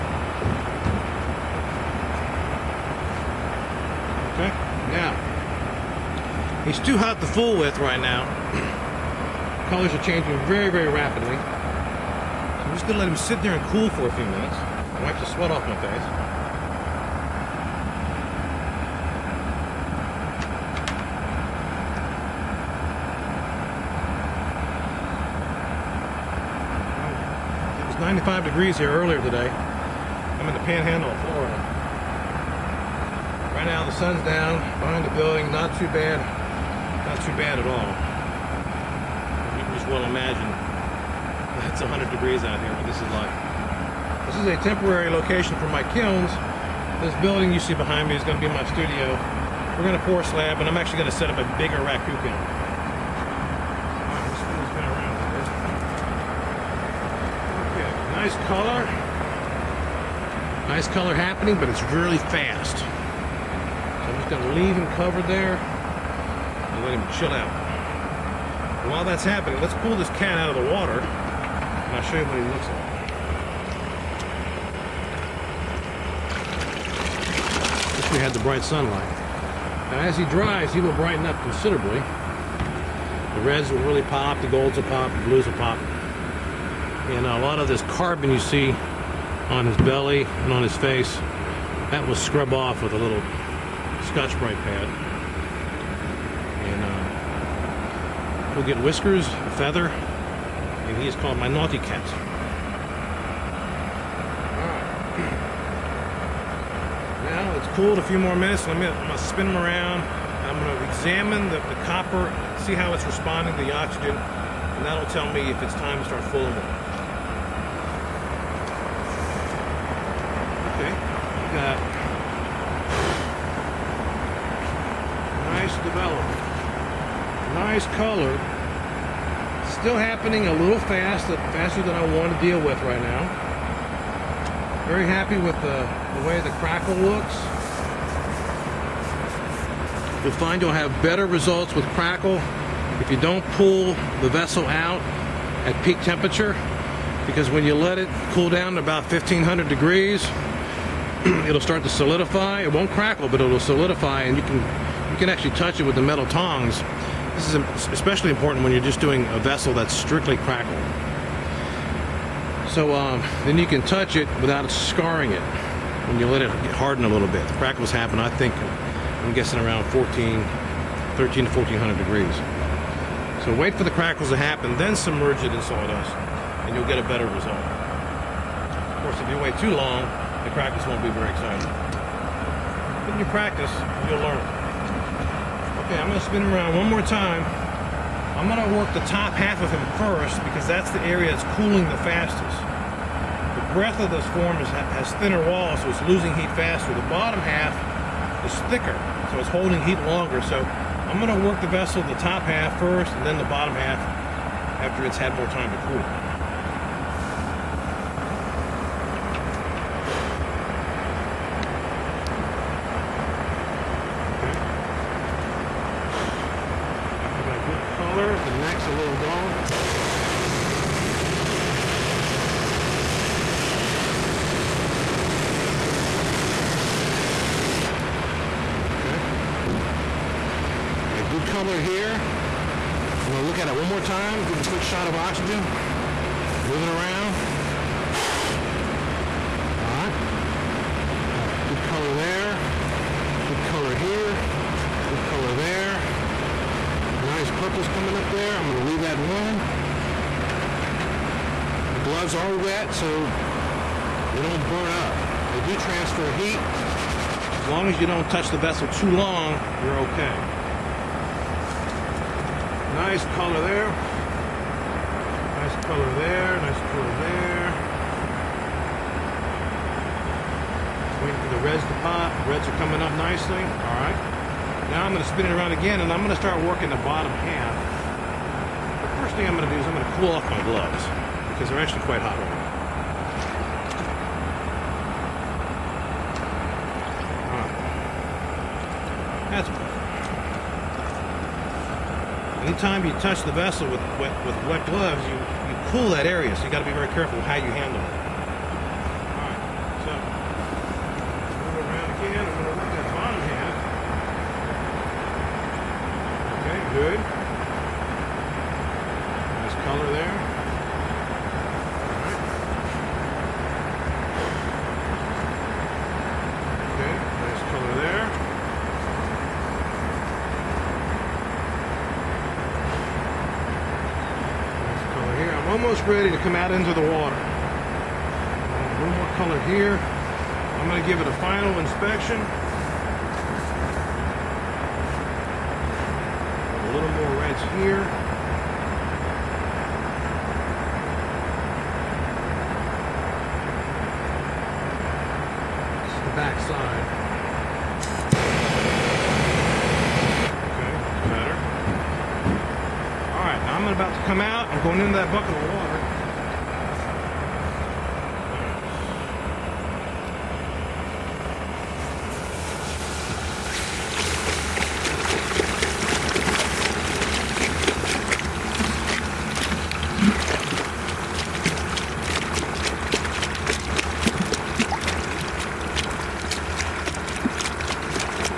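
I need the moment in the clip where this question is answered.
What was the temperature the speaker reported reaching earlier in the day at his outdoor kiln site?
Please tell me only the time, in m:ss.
0:27.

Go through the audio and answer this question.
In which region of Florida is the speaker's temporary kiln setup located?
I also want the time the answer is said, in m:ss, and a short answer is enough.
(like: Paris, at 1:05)
the panhandle, at 0:30.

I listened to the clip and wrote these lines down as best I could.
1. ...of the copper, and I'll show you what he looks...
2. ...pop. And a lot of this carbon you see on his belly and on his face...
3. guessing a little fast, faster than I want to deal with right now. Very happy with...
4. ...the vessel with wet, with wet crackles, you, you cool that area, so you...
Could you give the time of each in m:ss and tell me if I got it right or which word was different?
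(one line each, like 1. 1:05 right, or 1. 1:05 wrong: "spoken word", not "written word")
1. 1:10 wrong: "water", not "copper"
2. 1:25 right
3. 2:10 wrong: "happening", not "guessing"
4. 4:53 wrong: "gloves", not "crackles".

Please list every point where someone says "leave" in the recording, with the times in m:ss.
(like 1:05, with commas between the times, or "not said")
1:04, 4:08.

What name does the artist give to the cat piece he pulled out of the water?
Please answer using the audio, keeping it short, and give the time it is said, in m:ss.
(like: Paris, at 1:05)
naughty cat, at 1:41.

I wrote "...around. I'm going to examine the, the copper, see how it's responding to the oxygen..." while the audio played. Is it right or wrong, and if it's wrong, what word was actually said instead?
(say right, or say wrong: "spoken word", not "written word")
right.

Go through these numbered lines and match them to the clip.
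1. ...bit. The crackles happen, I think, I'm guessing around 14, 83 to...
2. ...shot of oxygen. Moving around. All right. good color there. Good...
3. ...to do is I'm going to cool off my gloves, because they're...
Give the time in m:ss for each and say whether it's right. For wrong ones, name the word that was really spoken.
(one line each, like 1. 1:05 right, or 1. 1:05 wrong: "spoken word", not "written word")
1. 2:47 wrong: "13", not "83"
2. 3:54 right
3. 4:39 right.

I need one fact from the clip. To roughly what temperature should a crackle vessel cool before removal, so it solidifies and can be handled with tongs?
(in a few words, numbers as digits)
1500 degrees.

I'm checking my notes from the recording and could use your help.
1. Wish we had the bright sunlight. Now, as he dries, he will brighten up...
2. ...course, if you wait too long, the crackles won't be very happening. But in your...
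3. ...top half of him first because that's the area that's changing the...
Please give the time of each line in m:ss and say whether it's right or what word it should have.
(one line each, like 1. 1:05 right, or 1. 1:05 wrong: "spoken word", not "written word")
1. 1:18 right
2. 2:59 wrong: "exciting", not "happening"
3. 3:09 wrong: "cooling", not "changing".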